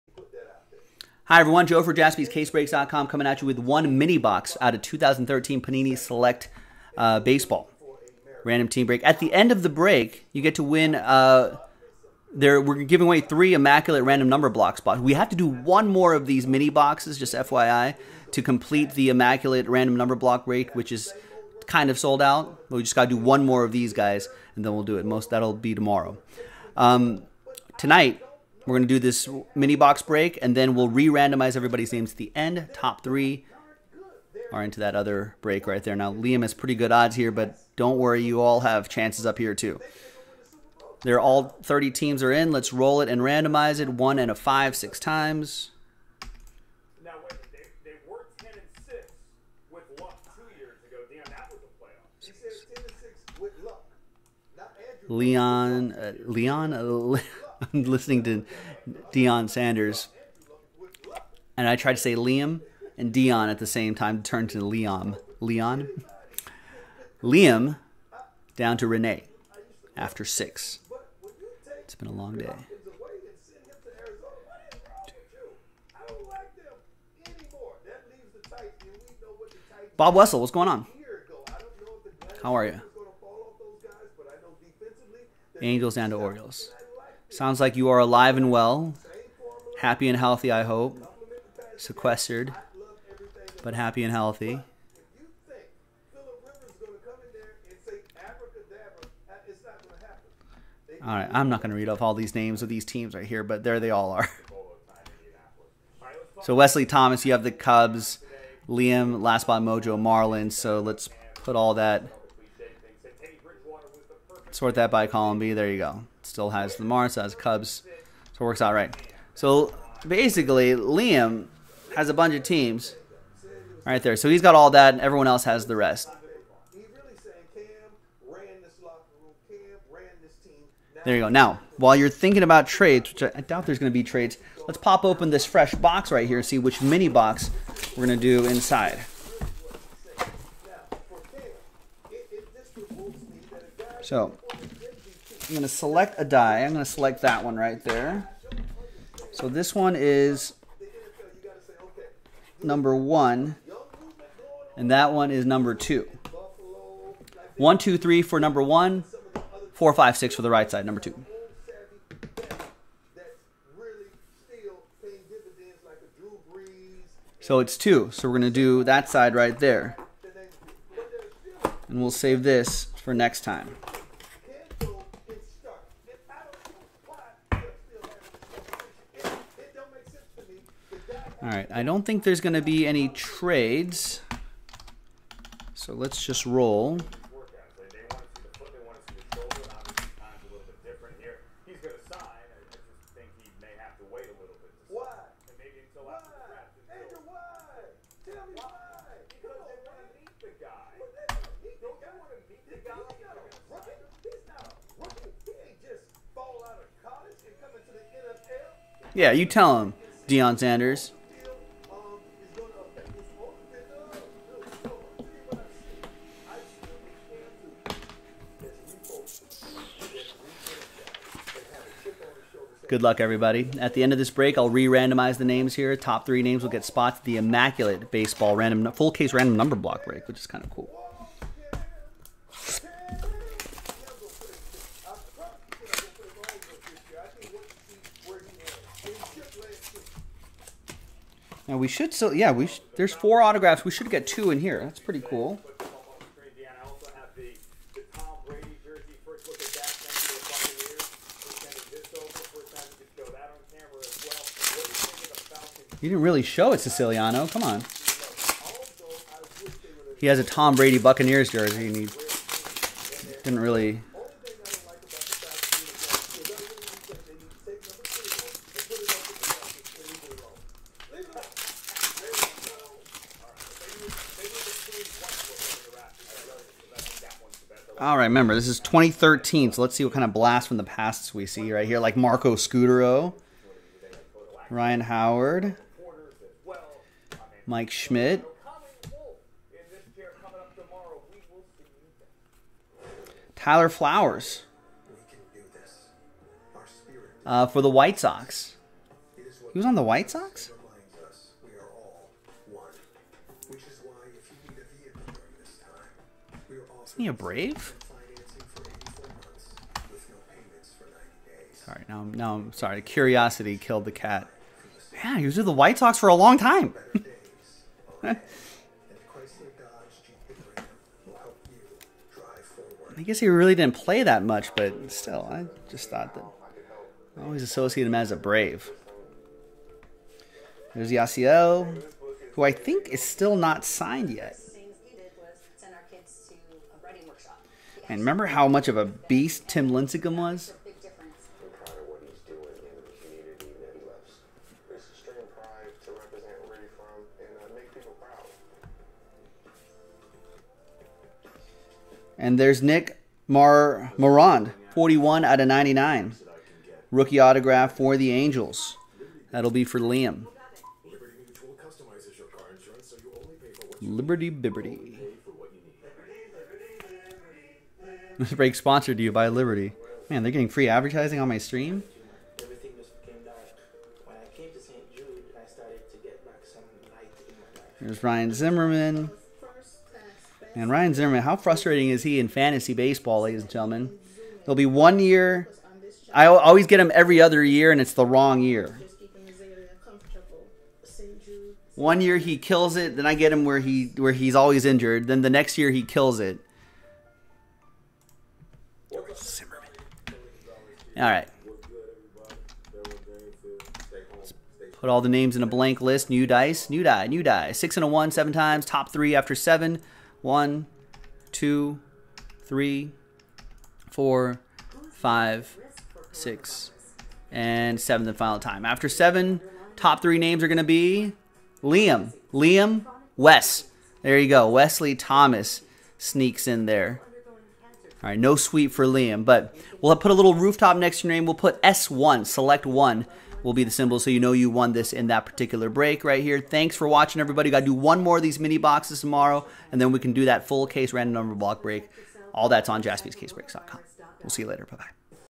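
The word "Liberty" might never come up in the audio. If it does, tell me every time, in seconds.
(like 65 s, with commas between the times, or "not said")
364 s, 369 s.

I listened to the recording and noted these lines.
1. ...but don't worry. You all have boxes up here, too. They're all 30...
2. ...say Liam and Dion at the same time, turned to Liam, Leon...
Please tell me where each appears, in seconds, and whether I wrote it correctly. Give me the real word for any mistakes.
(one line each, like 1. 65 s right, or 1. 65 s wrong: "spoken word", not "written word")
1. 37 s wrong: "chances", not "boxes"
2. 62 s right.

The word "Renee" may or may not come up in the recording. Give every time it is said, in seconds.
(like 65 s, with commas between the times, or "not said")
68 s.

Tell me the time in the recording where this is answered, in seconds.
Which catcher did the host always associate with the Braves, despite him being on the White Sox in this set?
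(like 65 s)
293 s.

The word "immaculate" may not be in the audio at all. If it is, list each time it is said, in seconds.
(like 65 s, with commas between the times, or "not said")
13 s, 19 s, 227 s.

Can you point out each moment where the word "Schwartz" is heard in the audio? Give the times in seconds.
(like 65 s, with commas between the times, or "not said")
not said.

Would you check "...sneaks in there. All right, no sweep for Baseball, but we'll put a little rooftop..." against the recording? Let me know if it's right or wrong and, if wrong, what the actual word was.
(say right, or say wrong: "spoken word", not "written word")
wrong: "Liam", not "Baseball".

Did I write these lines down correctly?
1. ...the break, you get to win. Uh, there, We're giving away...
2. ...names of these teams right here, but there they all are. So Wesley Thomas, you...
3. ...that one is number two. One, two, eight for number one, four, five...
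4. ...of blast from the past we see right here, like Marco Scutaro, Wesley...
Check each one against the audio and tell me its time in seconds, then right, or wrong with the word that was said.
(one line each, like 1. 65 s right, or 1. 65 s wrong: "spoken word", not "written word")
1. 9 s right
2. 102 s right
3. 154 s wrong: "three", not "eight"
4. 280 s wrong: "Ryan", not "Wesley".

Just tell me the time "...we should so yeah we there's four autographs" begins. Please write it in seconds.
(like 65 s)
241 s.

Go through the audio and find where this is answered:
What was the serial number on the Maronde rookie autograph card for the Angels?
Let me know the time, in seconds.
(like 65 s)
354 s.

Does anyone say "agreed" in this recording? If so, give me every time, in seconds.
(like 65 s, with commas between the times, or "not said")
not said.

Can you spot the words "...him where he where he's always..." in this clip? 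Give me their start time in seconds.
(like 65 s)
393 s.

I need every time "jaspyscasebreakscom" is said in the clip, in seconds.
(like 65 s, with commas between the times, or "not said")
1 s, 443 s.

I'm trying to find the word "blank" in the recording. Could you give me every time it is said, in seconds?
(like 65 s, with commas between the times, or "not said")
405 s.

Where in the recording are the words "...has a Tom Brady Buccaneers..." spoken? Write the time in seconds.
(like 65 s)
260 s.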